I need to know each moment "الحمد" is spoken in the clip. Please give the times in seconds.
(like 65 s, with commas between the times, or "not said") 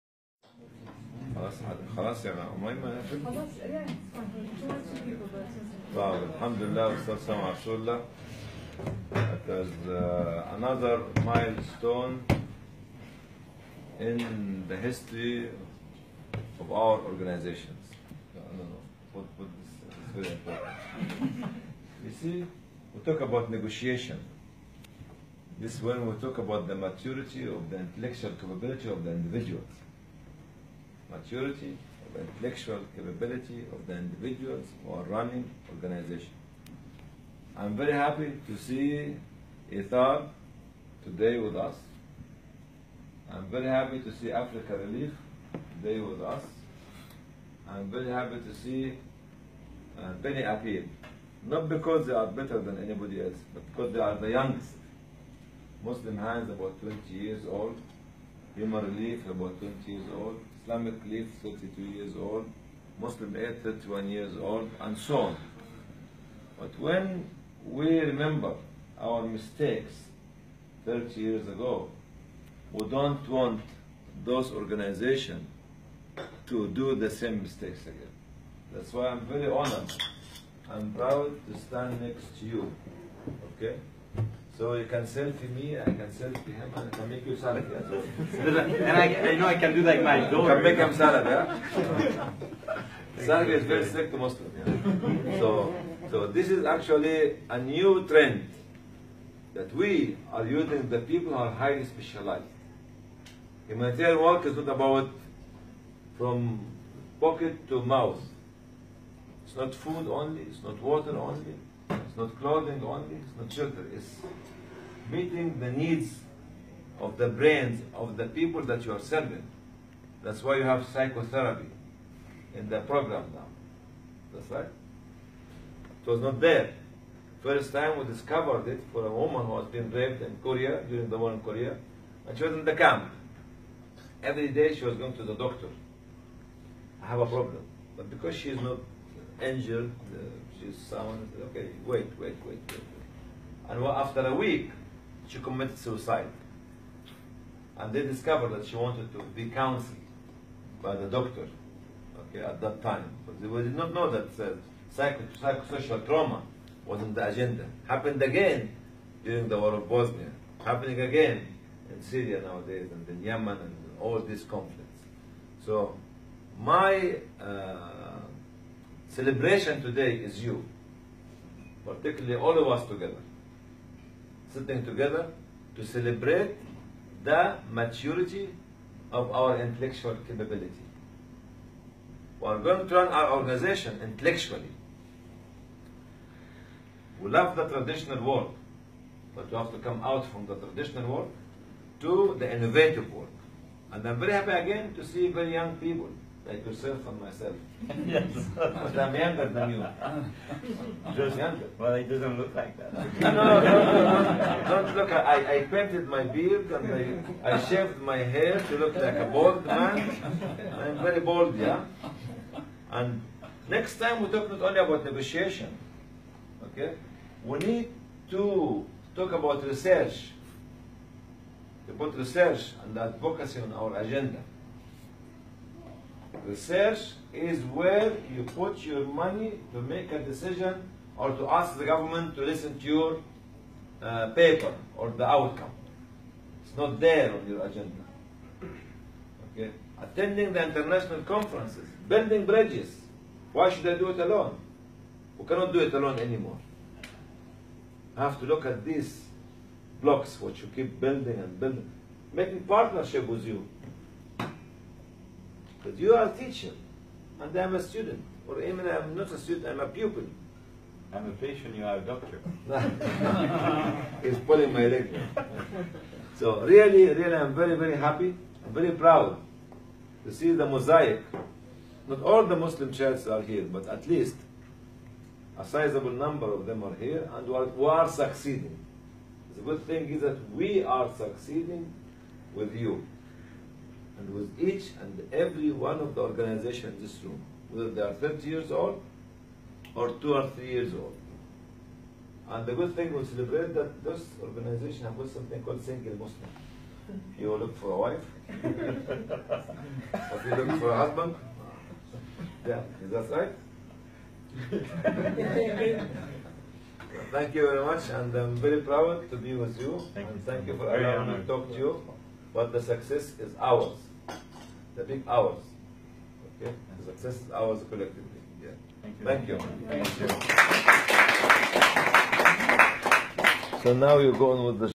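6 s.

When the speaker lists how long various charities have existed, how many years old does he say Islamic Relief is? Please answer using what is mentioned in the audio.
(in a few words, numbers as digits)
32.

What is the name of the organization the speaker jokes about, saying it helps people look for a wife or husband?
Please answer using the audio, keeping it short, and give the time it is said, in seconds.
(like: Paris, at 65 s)
Single Muslim, at 295 s.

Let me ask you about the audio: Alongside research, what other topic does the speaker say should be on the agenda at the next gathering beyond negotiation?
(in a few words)
advocacy.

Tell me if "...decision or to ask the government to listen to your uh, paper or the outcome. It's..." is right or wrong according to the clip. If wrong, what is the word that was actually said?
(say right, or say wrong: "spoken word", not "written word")
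right.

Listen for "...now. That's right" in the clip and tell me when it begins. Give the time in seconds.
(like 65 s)
123 s.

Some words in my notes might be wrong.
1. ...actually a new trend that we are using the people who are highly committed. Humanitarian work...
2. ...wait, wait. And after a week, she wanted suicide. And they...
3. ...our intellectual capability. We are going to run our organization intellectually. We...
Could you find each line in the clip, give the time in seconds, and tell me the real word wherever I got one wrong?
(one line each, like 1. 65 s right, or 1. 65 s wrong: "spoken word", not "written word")
1. 96 s wrong: "specialized", not "committed"
2. 142 s wrong: "committed", not "wanted"
3. 179 s right.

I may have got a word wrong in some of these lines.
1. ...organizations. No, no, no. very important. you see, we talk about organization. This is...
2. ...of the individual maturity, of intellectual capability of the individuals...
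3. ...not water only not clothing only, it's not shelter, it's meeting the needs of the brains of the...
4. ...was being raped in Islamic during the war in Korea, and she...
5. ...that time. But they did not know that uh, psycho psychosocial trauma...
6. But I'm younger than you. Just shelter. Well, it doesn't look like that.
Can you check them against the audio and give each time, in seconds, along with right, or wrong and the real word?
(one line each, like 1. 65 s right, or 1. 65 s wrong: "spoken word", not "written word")
1. 17 s wrong: "negotiation", not "organization"
2. 28 s right
3. 110 s right
4. 129 s wrong: "Korea", not "Islamic"
5. 152 s right
6. 198 s wrong: "younger", not "shelter".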